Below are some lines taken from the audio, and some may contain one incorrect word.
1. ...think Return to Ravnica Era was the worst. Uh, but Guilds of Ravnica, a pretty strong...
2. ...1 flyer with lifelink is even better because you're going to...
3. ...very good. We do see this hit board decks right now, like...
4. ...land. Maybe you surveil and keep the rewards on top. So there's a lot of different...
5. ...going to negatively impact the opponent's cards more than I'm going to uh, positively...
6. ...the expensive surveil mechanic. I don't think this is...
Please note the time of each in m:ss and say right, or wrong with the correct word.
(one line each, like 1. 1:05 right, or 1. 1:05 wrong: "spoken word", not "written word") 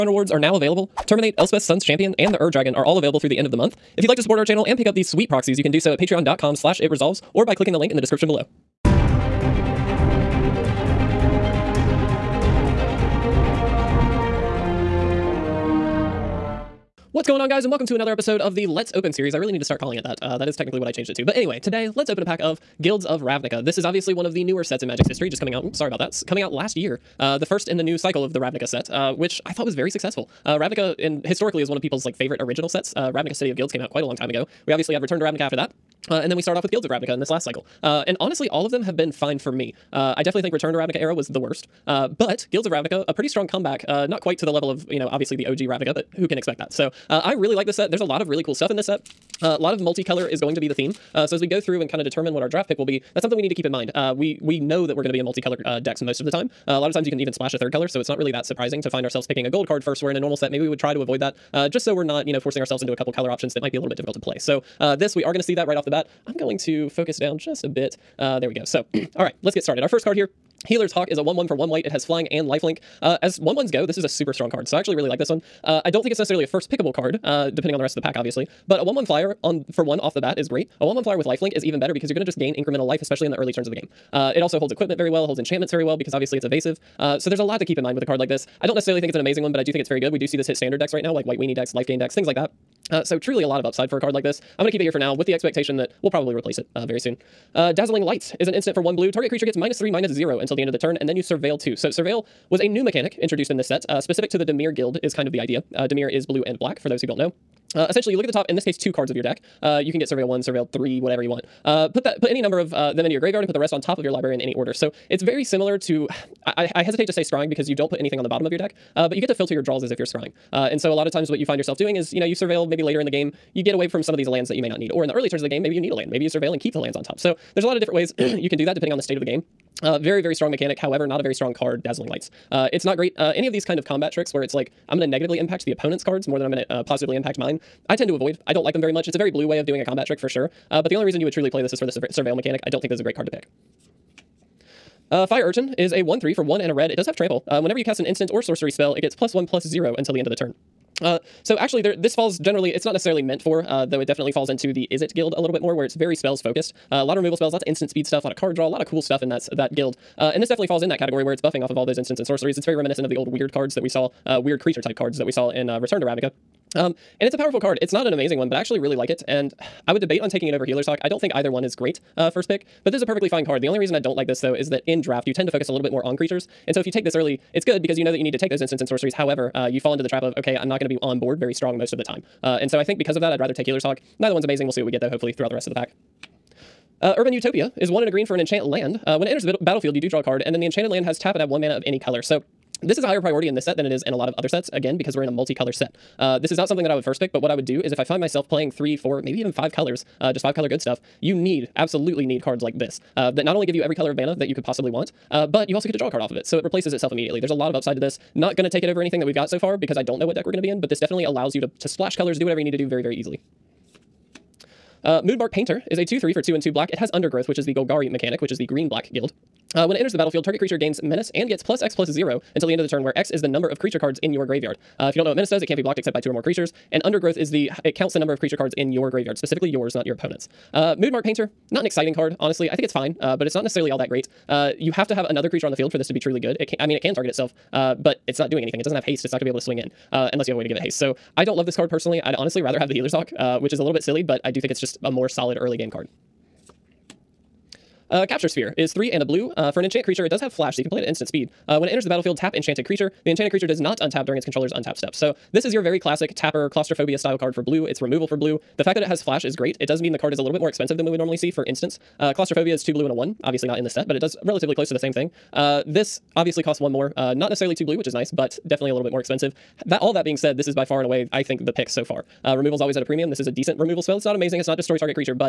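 1. 0:40 right
2. 1:20 right
3. 1:29 wrong: "standard", not "board"
4. 2:05 wrong: "lands", not "rewards"
5. 2:14 right
6. 2:21 wrong: "surve", not "expensive".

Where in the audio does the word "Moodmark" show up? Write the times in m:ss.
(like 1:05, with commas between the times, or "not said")
3:35, 3:50.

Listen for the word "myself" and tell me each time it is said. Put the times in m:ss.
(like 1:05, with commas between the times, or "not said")
3:18.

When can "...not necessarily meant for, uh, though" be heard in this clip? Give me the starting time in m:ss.
2:32.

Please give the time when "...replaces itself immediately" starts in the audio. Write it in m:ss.
3:26.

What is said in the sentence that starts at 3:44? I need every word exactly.
Uh, if you don't know what menace does, it can't be blocked except by two or more creatures.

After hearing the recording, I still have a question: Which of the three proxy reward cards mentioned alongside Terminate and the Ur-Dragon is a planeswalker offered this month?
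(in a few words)
Elspeth, Sun's Champion.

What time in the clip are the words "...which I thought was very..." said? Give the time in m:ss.
0:29.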